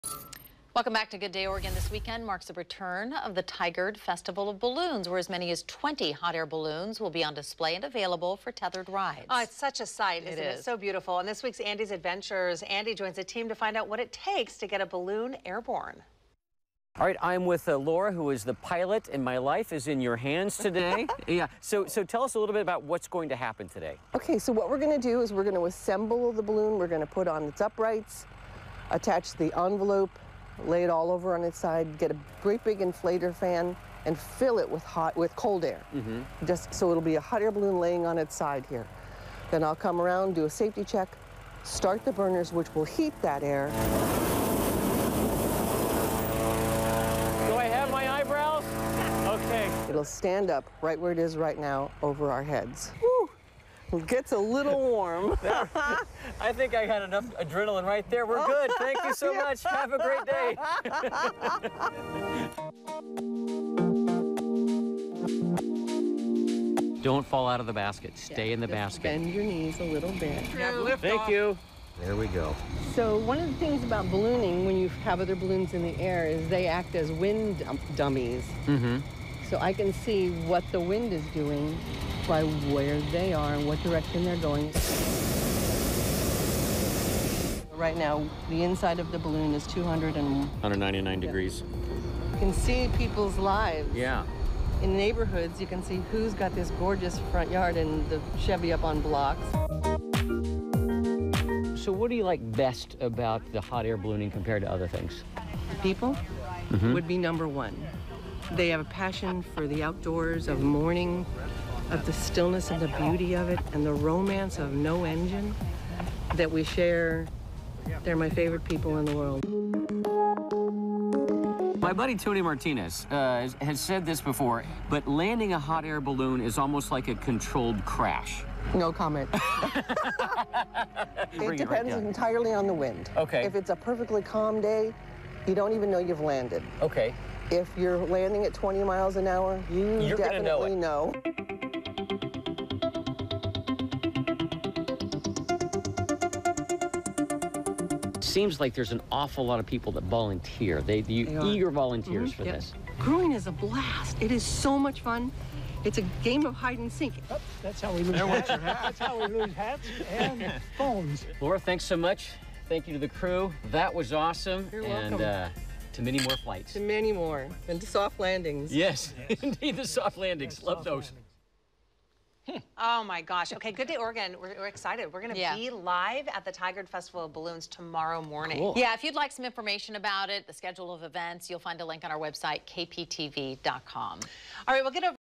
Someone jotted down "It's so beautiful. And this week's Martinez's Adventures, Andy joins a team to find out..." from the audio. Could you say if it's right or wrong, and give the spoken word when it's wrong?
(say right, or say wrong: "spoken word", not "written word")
wrong: "Andy", not "Martinez".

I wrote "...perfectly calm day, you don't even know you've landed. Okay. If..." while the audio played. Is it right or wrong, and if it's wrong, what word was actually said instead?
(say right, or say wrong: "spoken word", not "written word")
right.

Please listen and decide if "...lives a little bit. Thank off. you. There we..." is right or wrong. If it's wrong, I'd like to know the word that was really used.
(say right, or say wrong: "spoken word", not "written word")
wrong: "knees", not "lives".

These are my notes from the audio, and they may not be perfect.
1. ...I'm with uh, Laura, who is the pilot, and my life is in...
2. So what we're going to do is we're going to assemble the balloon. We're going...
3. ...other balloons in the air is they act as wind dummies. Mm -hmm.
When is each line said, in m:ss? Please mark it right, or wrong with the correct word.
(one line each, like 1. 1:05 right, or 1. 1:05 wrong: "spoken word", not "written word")
1. 0:17 right
2. 0:24 right
3. 1:15 right.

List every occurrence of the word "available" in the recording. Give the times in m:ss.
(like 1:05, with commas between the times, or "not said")
0:07.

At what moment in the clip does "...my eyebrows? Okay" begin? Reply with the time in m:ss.
0:47.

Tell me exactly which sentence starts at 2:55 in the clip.
be live at the Tigard Festival of Balloons tomorrow morning.